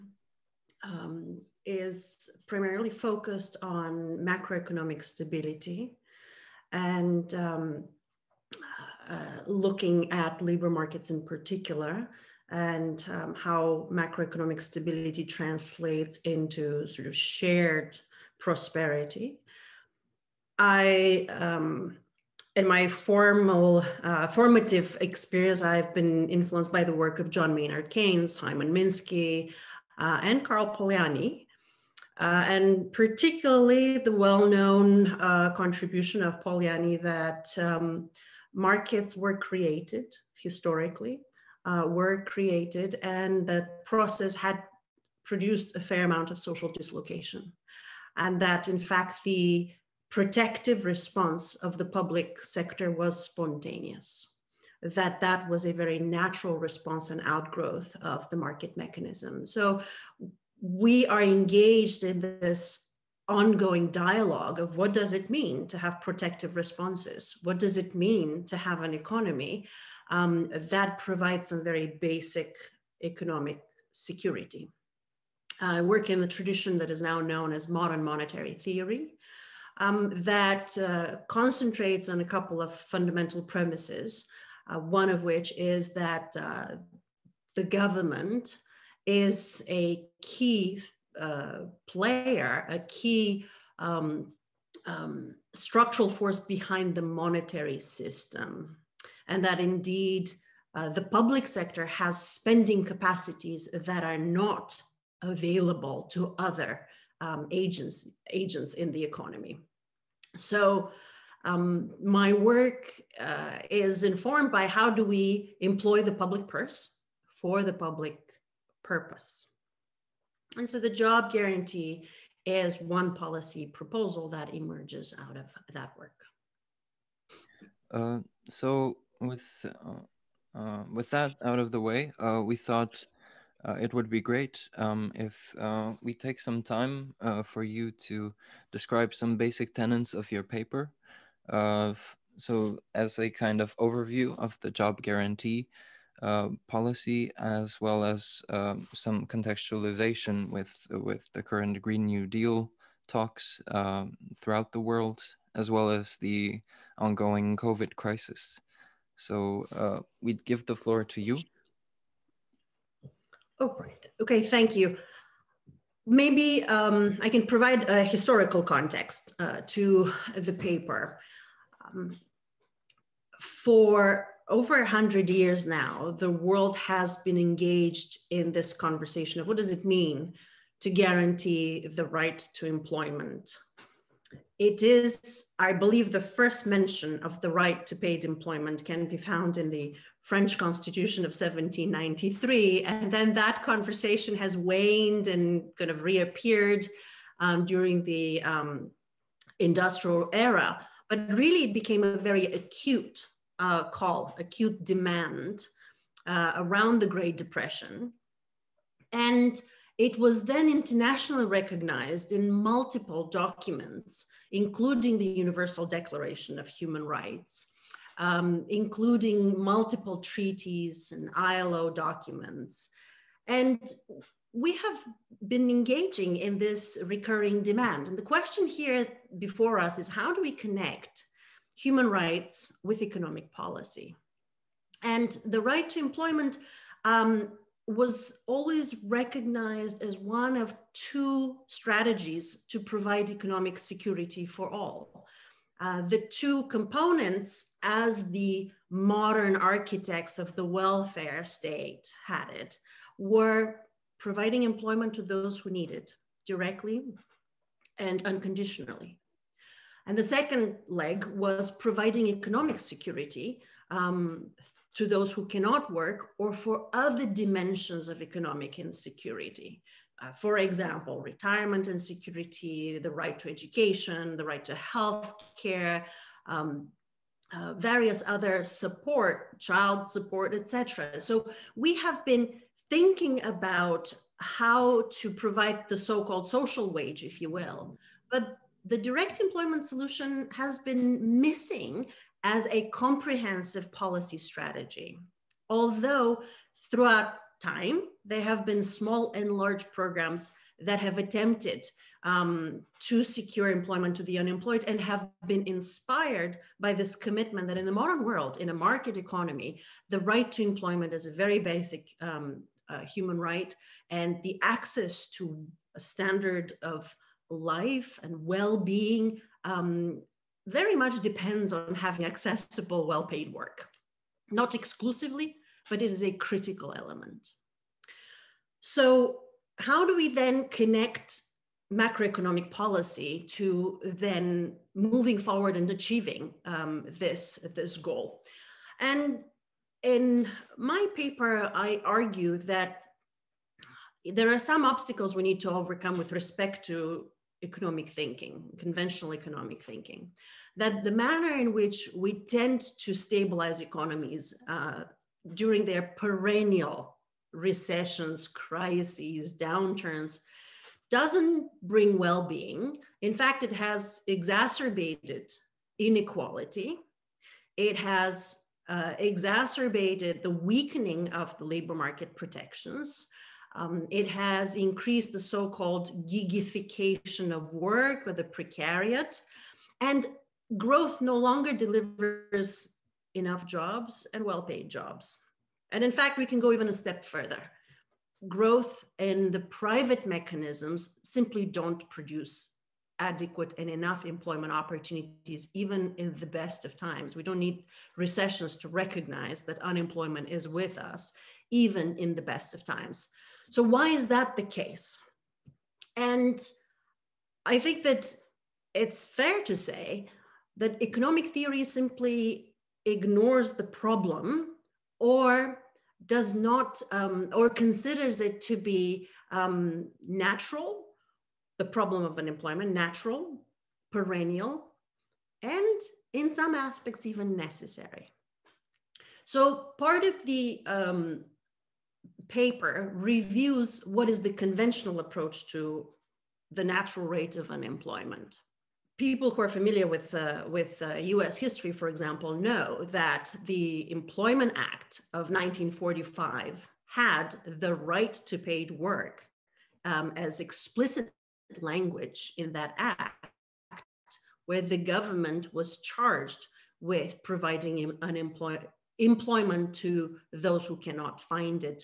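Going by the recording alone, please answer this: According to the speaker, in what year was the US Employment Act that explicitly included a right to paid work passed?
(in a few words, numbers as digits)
1945.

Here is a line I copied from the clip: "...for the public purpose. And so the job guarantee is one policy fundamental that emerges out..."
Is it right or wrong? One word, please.
wrong.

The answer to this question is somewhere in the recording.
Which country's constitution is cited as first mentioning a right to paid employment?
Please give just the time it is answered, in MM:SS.
03:10.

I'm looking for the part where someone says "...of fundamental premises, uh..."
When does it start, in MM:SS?
01:22.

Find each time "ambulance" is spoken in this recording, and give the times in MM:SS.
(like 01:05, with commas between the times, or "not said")
not said.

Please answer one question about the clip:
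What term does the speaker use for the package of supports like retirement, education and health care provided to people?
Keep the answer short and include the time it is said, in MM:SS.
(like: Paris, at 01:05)
social wage, at 04:46.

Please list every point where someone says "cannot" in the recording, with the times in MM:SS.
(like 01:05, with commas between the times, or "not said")
04:25, 07:40.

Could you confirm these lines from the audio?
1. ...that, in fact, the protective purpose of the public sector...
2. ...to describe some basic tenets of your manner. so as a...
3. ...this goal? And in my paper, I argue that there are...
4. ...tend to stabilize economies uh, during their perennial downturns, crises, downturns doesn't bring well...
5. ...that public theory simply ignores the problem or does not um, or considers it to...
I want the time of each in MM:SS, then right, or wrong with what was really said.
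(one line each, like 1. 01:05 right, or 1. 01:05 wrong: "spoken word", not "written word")
1. 00:48 wrong: "response", not "purpose"
2. 02:17 wrong: "paper", not "manner"
3. 05:37 right
4. 05:52 wrong: "recessions", not "downturns"
5. 06:50 wrong: "economic", not "public".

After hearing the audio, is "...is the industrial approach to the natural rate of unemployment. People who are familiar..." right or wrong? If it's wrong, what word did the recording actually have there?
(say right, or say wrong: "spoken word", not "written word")
wrong: "conventional", not "industrial".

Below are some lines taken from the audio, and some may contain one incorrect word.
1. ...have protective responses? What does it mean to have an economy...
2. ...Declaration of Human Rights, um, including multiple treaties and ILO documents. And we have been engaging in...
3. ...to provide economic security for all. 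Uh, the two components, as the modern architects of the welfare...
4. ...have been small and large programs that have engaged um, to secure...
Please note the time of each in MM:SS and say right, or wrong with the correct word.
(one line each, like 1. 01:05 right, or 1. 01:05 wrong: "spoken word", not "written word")
1. 01:05 right
2. 03:35 right
3. 04:02 right
4. 04:58 wrong: "attempted", not "engaged".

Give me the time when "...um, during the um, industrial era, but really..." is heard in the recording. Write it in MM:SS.
03:17.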